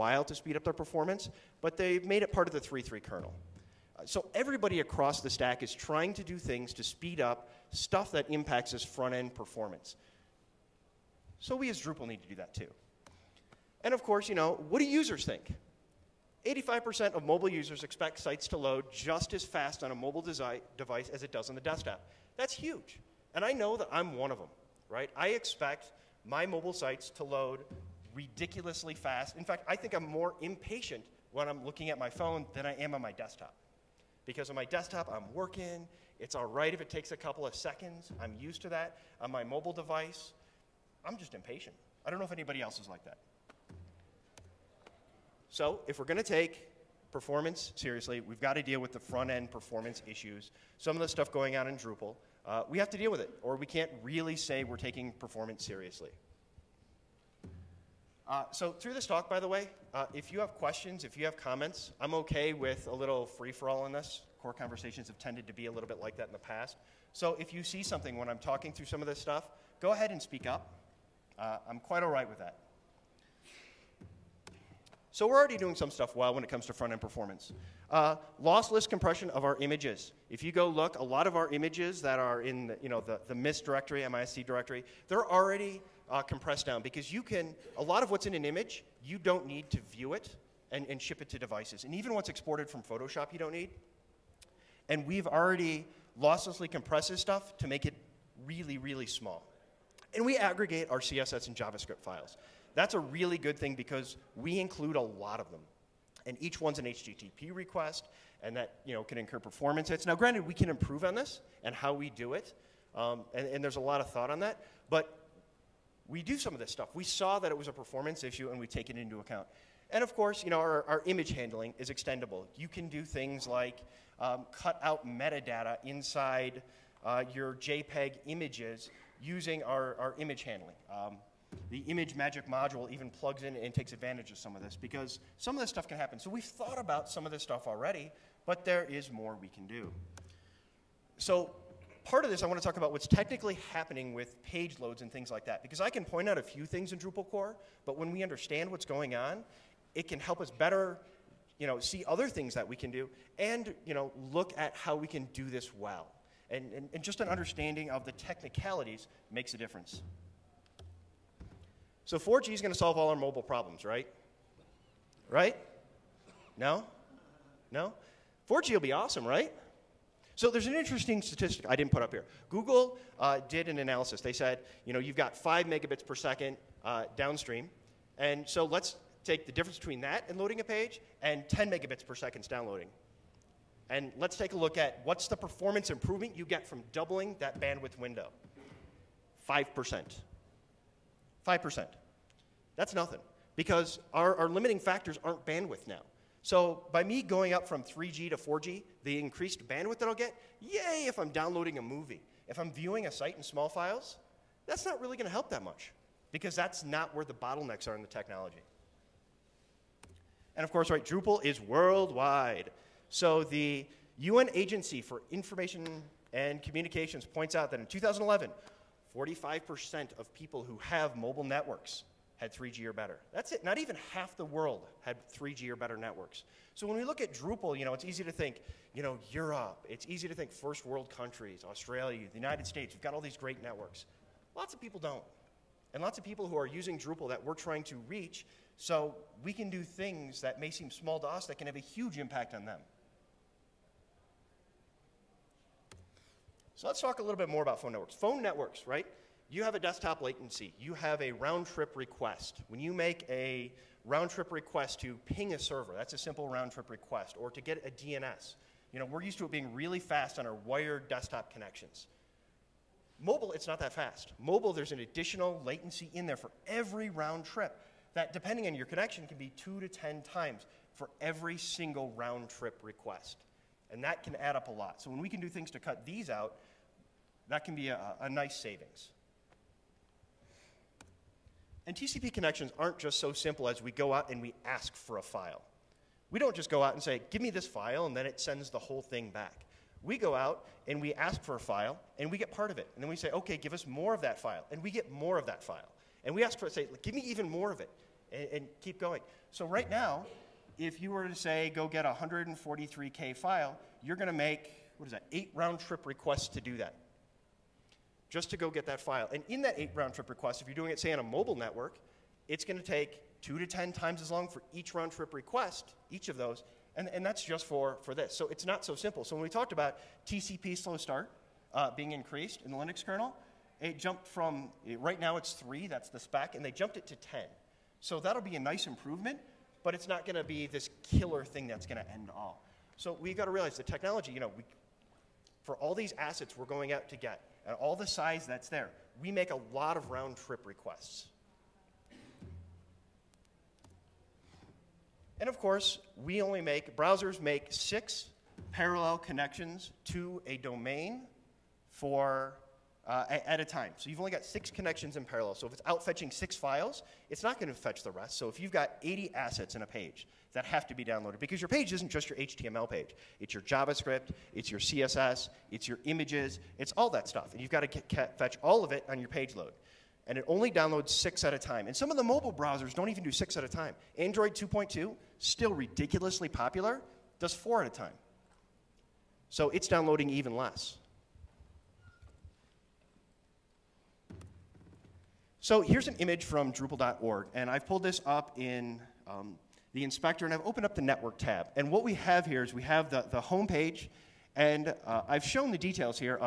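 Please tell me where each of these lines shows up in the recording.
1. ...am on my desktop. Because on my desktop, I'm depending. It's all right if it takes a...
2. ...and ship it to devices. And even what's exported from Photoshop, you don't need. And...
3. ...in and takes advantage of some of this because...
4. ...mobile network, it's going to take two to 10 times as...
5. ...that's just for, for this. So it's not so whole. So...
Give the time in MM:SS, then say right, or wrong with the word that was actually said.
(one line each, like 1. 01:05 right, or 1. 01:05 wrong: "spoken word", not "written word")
1. 00:32 wrong: "working", not "depending"
2. 01:30 right
3. 02:13 right
4. 05:11 right
5. 05:17 wrong: "simple", not "whole".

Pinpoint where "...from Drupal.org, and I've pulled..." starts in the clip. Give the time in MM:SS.
06:26.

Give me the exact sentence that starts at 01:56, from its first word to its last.
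We saw that it was a performance issue, and we take it into account.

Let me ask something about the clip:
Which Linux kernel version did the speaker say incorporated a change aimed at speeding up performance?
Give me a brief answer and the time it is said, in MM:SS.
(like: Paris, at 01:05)
3.3, at 00:02.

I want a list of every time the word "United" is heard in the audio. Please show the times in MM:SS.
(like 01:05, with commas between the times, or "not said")
03:52.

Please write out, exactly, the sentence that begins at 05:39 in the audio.
We make a lot of round trip requests.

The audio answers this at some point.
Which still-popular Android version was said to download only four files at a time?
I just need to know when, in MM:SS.
06:14.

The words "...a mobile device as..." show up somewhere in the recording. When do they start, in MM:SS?
00:19.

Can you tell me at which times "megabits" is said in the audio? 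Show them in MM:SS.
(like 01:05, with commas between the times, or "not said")
02:55, 03:01.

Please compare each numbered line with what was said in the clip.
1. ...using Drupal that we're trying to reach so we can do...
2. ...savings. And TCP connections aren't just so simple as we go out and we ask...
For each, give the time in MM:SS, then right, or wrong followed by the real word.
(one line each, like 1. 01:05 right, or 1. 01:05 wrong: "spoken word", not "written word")
1. 03:56 right
2. 04:38 right.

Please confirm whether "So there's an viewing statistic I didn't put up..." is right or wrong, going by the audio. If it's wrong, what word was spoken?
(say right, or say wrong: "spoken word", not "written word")
wrong: "interesting", not "viewing".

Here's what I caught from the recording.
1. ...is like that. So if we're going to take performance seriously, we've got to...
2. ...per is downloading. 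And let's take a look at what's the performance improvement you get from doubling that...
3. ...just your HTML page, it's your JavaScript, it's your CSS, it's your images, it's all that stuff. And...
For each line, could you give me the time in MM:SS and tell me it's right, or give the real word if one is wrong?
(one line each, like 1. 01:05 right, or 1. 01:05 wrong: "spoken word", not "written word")
1. 00:42 right
2. 03:02 right
3. 06:02 right.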